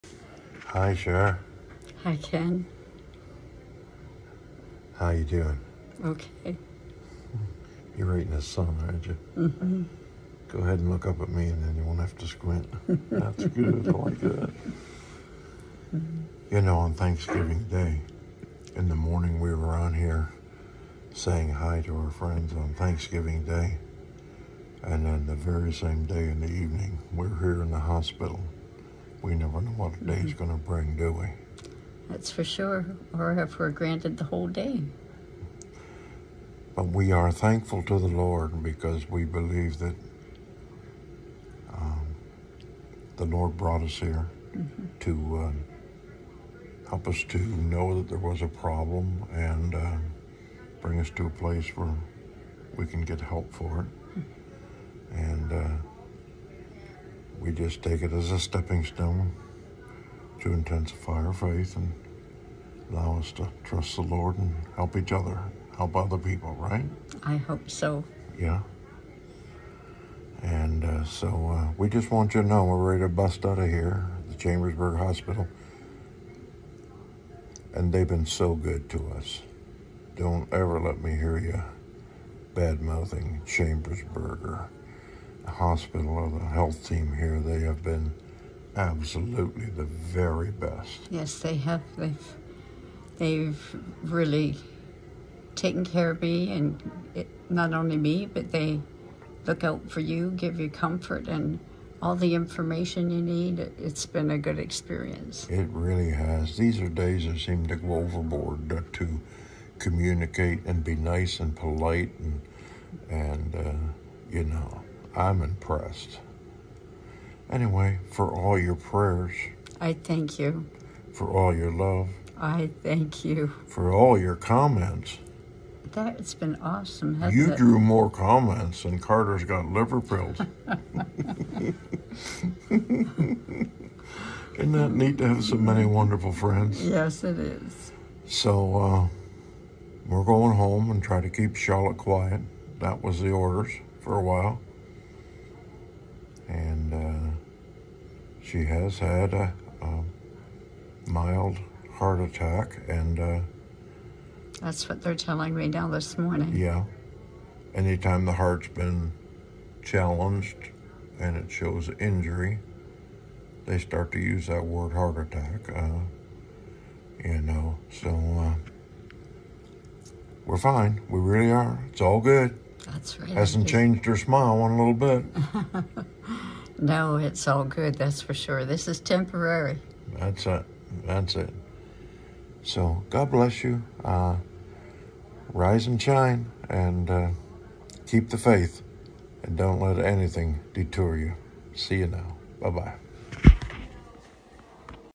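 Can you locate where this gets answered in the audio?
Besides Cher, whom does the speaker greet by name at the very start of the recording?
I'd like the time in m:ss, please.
0:02.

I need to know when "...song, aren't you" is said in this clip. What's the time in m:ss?
0:08.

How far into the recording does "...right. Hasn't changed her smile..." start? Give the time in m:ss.
2:53.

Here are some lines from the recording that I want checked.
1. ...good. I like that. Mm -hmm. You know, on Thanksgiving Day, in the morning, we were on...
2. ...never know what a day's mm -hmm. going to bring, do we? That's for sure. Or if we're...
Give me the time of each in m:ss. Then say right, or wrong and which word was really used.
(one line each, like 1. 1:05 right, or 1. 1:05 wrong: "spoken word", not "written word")
1. 0:13 right
2. 0:29 right.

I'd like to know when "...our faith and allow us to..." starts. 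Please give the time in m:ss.
1:01.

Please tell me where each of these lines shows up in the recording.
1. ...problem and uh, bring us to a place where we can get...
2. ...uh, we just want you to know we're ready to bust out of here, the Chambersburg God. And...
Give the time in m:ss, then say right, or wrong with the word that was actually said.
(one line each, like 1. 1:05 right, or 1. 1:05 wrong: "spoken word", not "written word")
1. 0:48 right
2. 1:11 wrong: "Hospital", not "God".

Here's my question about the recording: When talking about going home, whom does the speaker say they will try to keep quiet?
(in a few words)
Charlotte.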